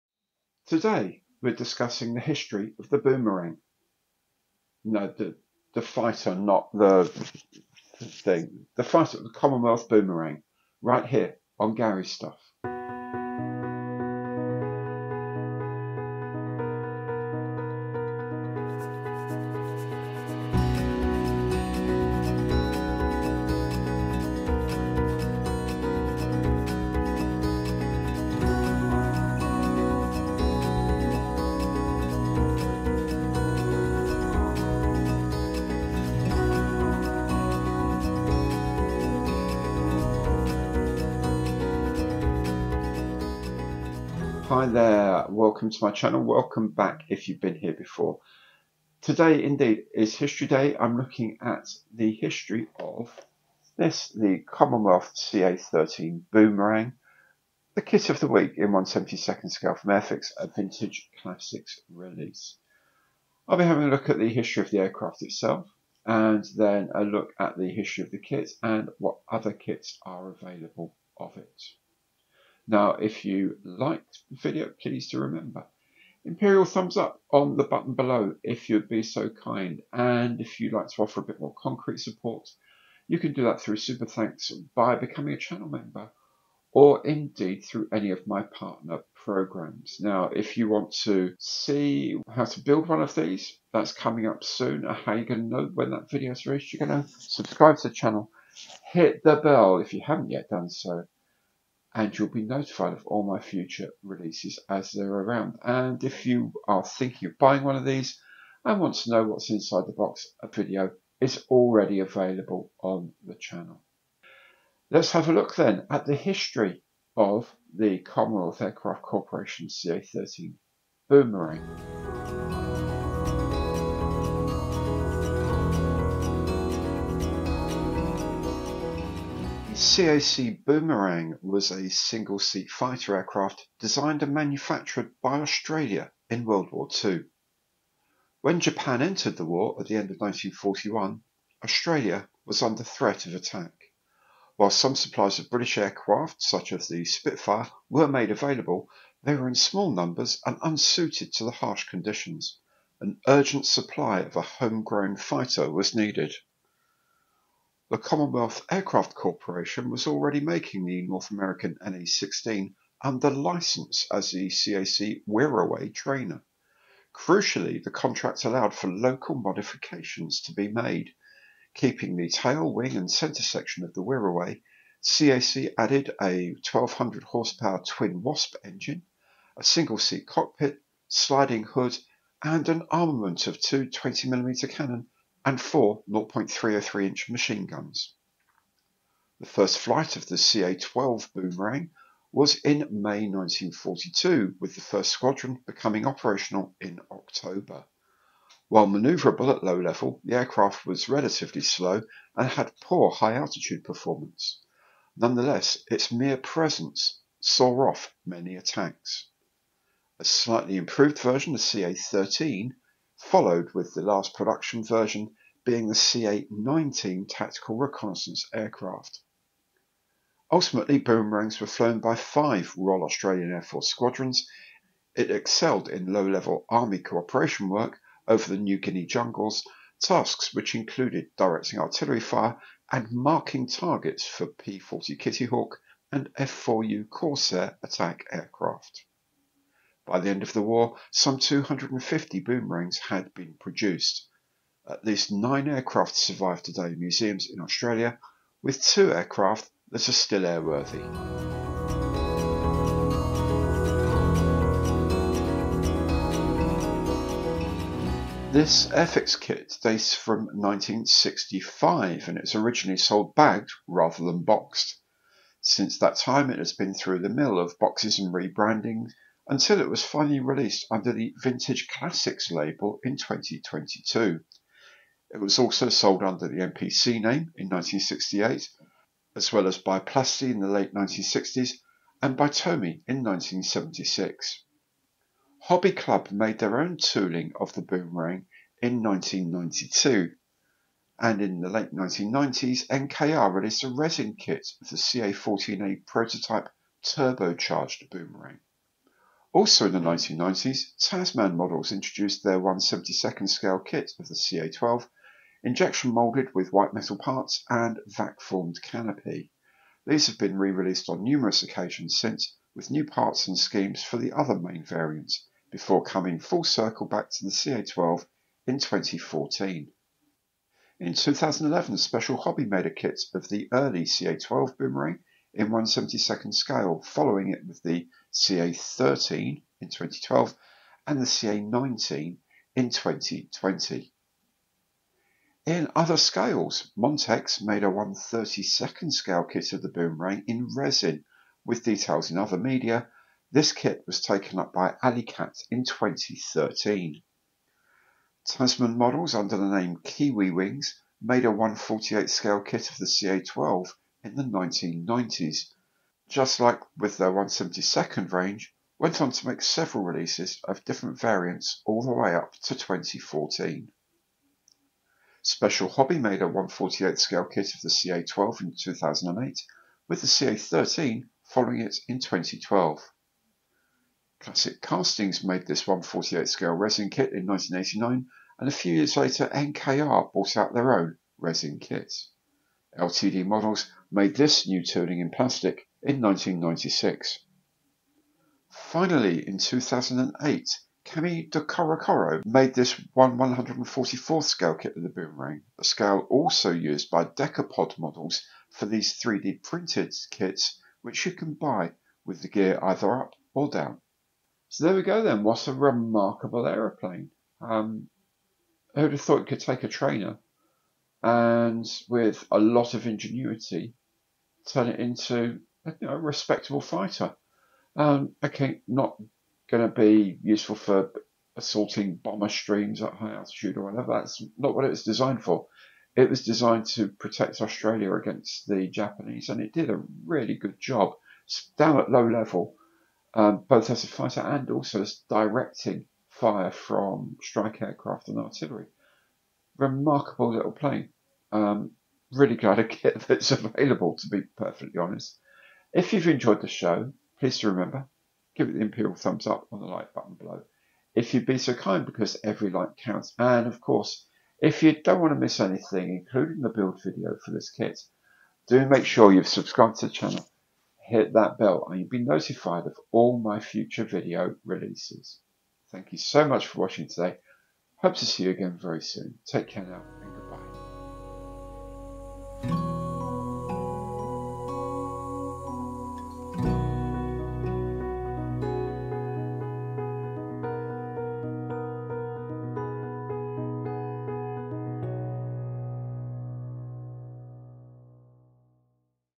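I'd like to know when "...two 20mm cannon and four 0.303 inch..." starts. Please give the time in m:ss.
3:03.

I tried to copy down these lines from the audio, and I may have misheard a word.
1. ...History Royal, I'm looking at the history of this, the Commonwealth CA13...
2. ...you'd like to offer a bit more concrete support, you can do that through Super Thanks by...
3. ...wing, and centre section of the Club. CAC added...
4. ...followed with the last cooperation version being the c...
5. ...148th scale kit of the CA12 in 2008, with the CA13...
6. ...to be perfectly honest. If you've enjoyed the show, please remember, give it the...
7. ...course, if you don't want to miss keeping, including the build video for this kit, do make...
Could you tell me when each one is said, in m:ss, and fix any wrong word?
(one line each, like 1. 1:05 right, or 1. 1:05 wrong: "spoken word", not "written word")
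1. 0:50 wrong: "Day", not "Royal"
2. 1:20 right
3. 2:52 wrong: "Wirraway", not "Club"
4. 3:33 wrong: "production", not "cooperation"
5. 6:06 right
6. 7:24 right
7. 7:33 wrong: "anything", not "keeping".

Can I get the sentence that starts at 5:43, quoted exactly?
This kit was taken up by Alley Cat in 2013.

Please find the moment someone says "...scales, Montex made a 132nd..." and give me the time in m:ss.
5:36.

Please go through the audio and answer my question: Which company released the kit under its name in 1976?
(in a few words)
Tomy.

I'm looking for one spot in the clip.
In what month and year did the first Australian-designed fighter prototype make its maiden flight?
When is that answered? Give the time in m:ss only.
3:12.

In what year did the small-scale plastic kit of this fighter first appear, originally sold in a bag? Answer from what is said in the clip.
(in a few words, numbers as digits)
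1965.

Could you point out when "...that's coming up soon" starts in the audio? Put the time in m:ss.
1:33.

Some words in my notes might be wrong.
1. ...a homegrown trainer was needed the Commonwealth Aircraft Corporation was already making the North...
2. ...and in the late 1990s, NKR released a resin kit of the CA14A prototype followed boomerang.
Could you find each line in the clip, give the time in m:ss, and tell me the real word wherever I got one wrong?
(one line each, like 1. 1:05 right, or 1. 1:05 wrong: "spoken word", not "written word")
1. 2:34 wrong: "fighter", not "trainer"
2. 4:51 wrong: "turbocharged", not "followed".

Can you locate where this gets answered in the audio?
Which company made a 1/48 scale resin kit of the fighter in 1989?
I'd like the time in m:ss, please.
6:14.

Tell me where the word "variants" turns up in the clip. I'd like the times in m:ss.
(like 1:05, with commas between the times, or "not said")
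5:14, 6:01.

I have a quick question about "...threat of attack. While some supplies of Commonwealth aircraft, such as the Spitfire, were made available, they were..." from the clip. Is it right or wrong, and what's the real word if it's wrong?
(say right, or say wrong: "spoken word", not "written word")
wrong: "British", not "Commonwealth".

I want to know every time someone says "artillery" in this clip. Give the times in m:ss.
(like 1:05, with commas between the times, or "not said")
3:51, 7:18.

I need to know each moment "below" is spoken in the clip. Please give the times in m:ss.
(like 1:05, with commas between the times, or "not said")
1:17, 7:30.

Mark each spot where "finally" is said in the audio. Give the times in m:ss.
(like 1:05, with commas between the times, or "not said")
4:30, 6:28.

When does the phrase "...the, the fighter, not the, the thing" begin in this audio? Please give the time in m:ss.
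0:05.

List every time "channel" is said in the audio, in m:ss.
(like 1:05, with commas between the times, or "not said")
0:45, 1:25, 1:37, 1:53, 7:40.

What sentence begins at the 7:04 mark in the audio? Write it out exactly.
That's not what it was designed for.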